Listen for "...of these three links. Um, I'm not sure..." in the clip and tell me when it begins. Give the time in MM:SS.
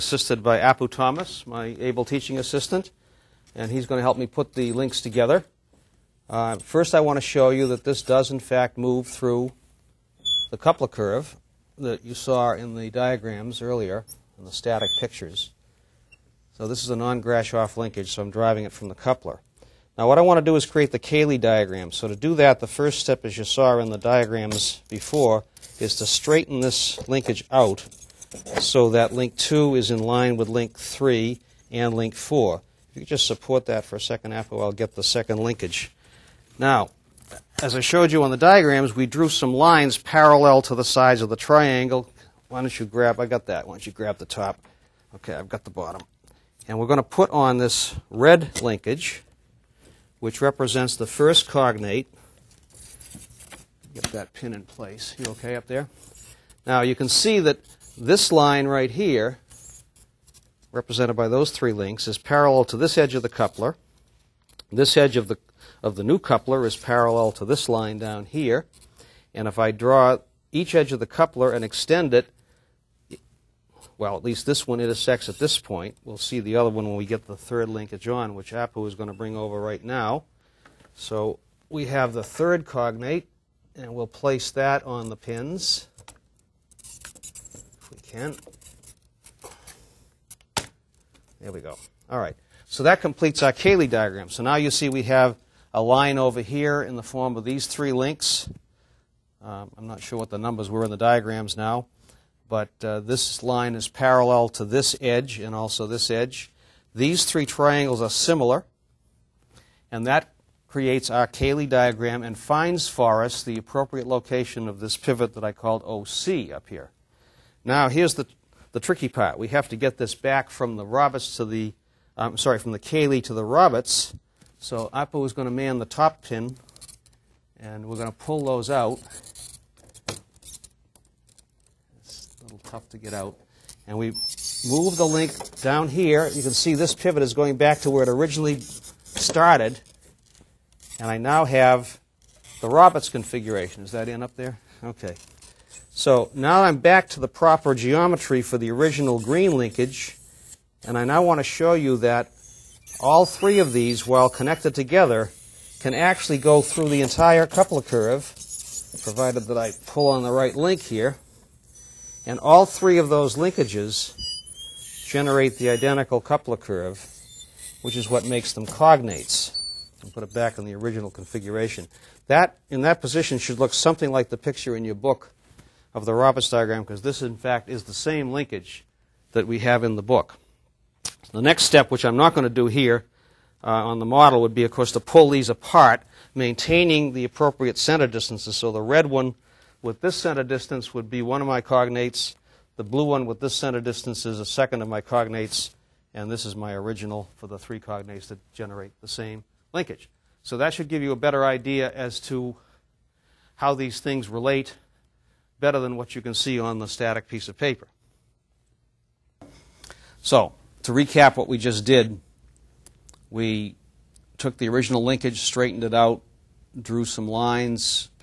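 01:37.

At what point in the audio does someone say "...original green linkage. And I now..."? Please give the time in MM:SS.
02:28.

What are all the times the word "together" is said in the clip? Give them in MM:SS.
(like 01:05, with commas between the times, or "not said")
00:04, 02:34.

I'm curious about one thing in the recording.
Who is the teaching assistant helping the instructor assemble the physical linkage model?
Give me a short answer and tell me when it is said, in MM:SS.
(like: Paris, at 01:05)
Apu Thomas, at 00:00.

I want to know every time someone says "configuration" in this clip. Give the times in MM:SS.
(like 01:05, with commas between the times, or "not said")
02:23, 02:51.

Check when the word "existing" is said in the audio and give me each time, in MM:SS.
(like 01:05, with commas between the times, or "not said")
not said.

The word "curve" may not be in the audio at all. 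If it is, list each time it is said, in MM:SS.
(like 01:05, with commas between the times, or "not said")
00:10, 02:37, 02:46.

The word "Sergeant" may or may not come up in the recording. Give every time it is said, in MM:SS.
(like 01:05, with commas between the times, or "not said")
not said.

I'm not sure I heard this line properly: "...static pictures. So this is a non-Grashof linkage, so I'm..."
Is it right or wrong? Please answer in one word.
right.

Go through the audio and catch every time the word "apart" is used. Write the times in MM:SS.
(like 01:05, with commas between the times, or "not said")
03:05.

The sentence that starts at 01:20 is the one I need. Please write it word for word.
So we have the third cognate, and we'll place that on the pins, if we can.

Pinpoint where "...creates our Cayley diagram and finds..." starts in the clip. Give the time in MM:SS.
01:50.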